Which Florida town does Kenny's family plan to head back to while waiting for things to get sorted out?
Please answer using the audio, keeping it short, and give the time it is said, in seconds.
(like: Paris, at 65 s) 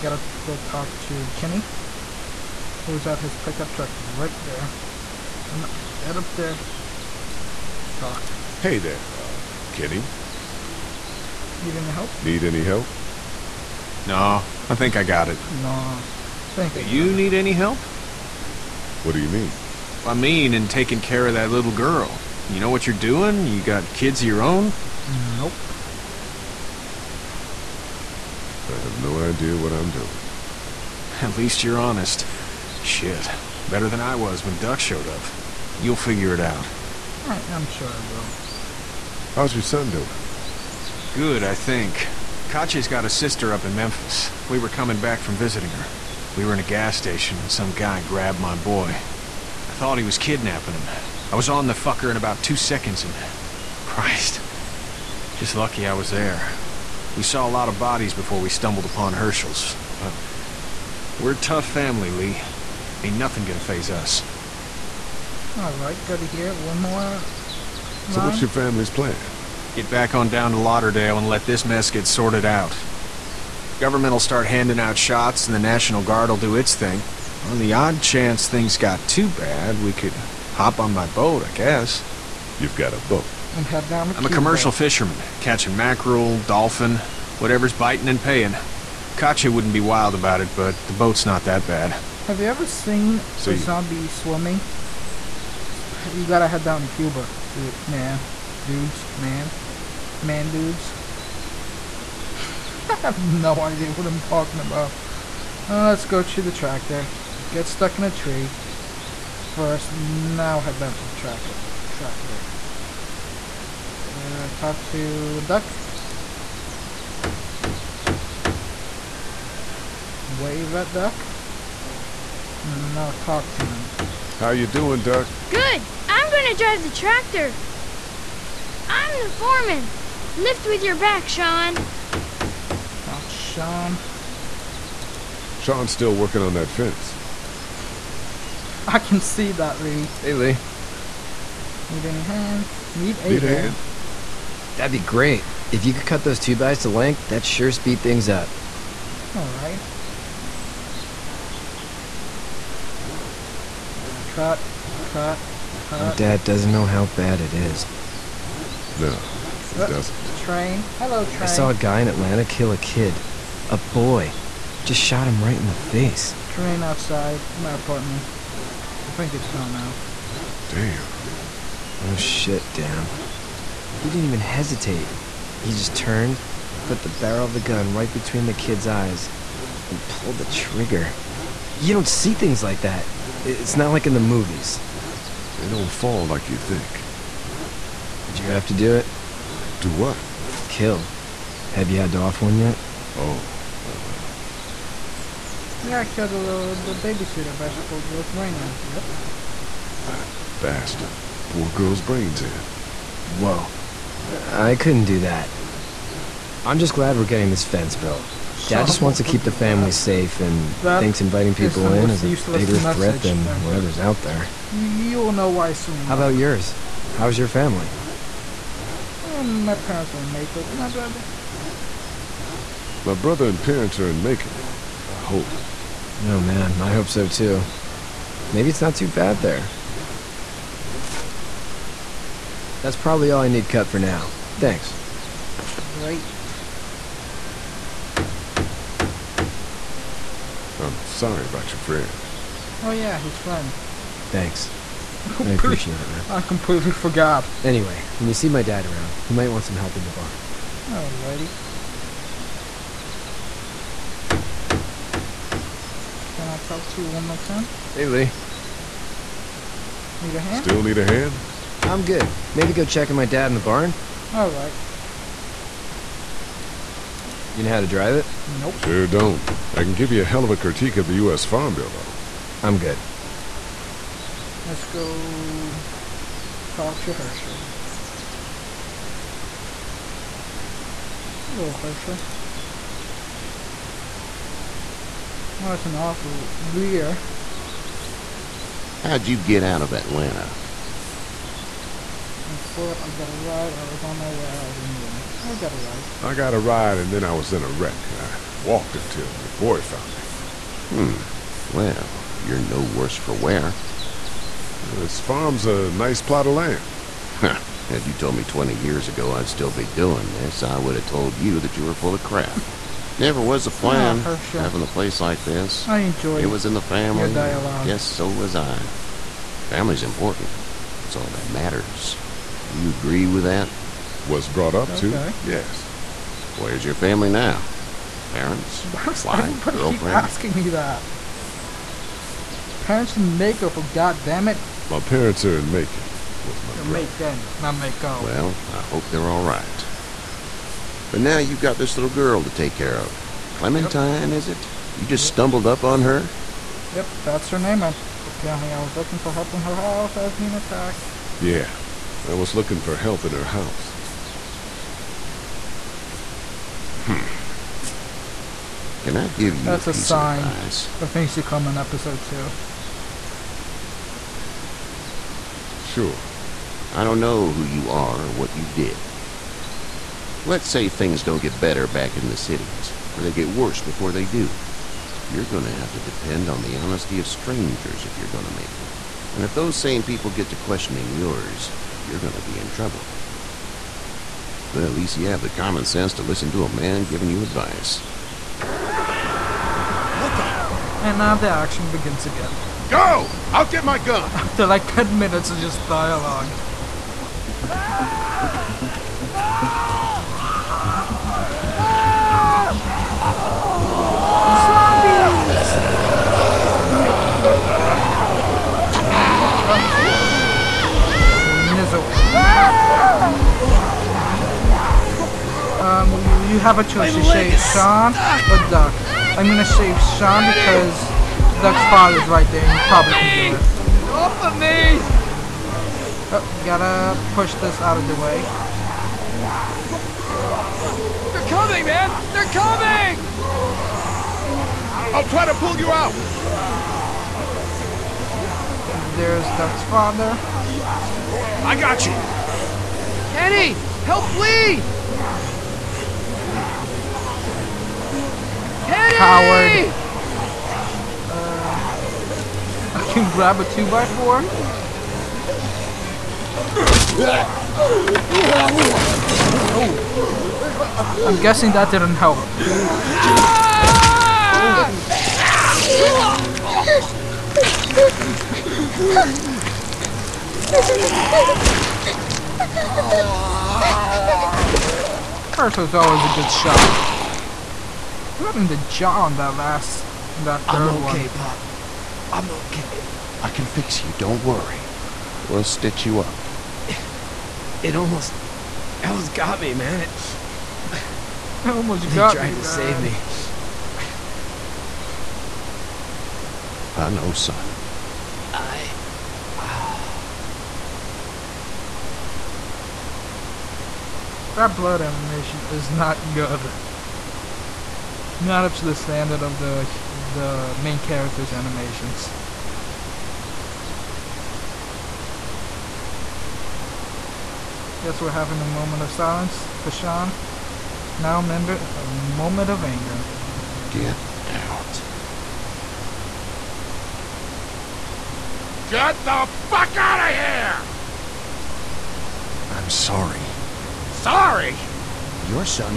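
Lauderdale, at 70 s.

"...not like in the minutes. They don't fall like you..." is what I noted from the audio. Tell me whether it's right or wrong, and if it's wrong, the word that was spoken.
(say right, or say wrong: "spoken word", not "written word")
wrong: "movies", not "minutes".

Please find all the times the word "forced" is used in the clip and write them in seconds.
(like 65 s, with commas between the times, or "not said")
not said.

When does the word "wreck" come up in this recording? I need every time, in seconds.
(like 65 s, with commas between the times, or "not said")
297 s.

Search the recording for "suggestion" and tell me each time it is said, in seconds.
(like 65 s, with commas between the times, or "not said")
not said.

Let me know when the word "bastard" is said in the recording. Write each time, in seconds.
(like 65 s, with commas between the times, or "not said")
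200 s.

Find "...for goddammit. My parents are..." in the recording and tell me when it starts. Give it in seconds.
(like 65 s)
333 s.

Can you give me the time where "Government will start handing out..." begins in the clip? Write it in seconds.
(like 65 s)
73 s.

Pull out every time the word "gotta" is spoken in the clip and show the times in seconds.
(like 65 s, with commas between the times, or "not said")
96 s, 426 s.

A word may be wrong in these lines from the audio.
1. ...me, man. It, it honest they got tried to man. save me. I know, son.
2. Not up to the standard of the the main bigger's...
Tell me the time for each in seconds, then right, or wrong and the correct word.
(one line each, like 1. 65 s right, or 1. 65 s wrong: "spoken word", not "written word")
1. 489 s wrong: "almost", not "honest"
2. 508 s wrong: "character", not "bigger".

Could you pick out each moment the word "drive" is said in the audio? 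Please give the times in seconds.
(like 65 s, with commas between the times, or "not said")
126 s, 267 s.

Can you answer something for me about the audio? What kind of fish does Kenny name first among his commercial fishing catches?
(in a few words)
Mackerel.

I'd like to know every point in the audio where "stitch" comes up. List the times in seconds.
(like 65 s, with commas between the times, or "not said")
485 s.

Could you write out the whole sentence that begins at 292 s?
On foot, I got a ride.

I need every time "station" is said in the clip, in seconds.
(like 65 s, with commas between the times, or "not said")
46 s.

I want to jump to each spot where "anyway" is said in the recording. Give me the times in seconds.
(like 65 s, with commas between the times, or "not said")
247 s, 294 s.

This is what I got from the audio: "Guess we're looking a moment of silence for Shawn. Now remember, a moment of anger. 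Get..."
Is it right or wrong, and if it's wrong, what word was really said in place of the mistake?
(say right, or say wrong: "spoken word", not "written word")
wrong: "having", not "looking".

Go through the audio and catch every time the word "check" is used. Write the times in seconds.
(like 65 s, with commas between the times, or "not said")
262 s.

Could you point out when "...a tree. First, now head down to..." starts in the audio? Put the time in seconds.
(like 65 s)
108 s.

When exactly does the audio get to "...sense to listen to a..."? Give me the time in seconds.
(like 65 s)
385 s.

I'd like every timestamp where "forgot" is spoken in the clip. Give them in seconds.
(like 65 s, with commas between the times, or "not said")
246 s.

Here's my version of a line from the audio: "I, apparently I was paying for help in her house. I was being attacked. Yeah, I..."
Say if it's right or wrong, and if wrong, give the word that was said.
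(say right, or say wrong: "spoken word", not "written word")
wrong: "looking", not "paying".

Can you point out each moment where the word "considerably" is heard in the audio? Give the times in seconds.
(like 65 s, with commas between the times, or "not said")
not said.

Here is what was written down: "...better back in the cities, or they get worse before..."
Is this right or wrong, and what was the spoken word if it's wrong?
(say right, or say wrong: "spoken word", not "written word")
right.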